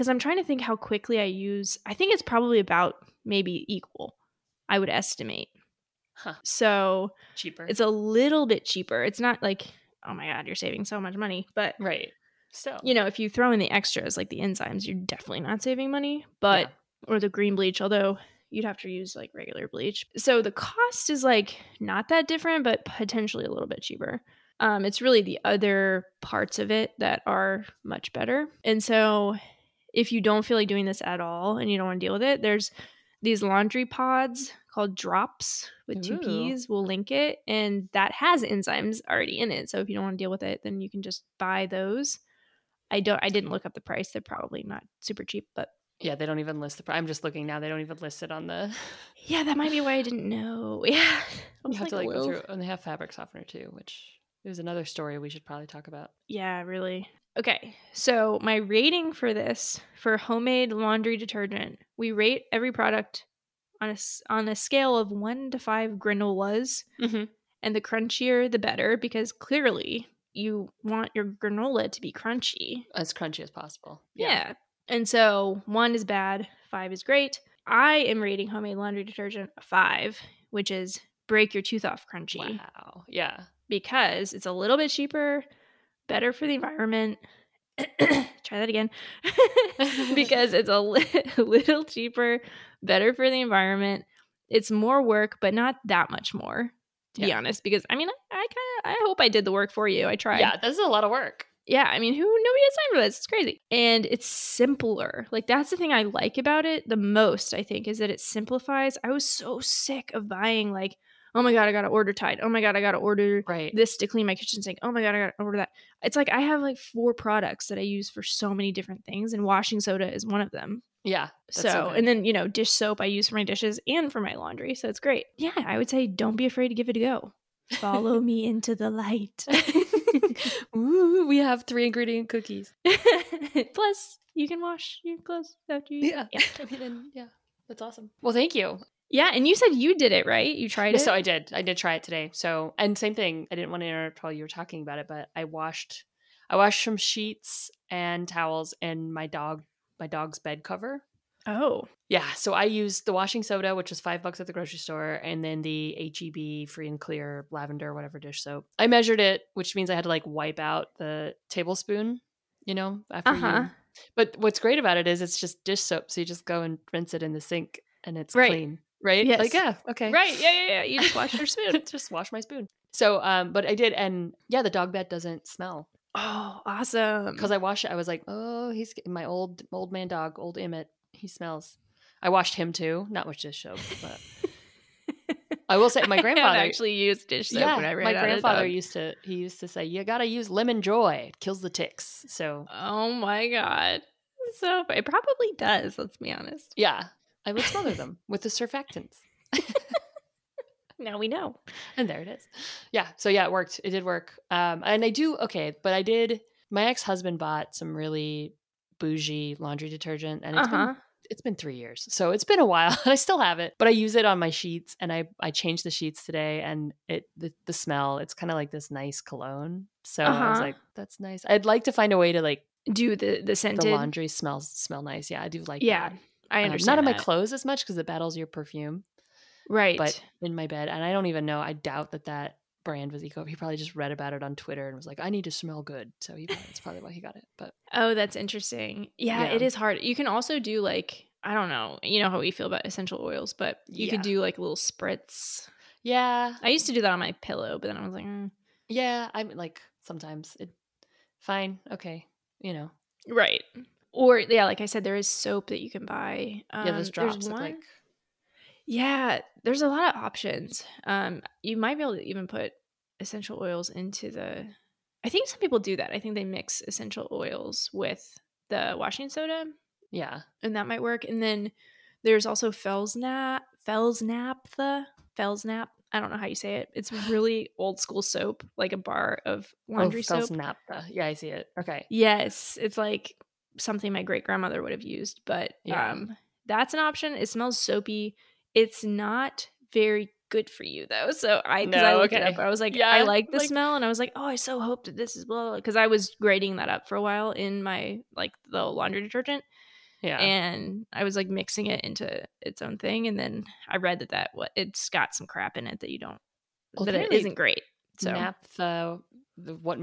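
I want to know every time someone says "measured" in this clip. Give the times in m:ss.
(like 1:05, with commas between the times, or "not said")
2:38.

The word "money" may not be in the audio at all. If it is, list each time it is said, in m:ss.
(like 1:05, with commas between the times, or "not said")
0:11, 0:15.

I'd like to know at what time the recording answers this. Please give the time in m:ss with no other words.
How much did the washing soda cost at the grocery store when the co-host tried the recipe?
2:34.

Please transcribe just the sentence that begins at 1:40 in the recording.
Yeah, this is a lot of work.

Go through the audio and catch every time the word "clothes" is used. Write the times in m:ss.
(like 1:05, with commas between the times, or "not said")
2:15, 3:47.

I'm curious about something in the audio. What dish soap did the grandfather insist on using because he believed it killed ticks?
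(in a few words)
Lemon Joy.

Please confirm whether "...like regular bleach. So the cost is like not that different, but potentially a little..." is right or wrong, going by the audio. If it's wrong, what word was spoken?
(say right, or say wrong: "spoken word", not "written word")
right.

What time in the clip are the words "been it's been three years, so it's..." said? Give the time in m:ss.
3:30.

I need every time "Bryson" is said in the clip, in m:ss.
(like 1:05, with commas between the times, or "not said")
not said.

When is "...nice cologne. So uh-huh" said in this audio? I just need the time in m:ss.
3:38.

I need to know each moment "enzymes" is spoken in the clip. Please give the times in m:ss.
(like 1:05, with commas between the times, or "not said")
0:14, 0:38.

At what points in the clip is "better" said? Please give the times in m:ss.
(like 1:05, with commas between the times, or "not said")
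0:28, 1:08, 1:26, 1:32.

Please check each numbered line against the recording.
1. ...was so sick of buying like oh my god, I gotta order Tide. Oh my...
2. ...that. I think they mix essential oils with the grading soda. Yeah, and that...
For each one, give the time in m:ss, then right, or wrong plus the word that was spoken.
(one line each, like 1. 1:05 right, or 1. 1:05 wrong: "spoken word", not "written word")
1. 1:49 right
2. 4:25 wrong: "washing", not "grading".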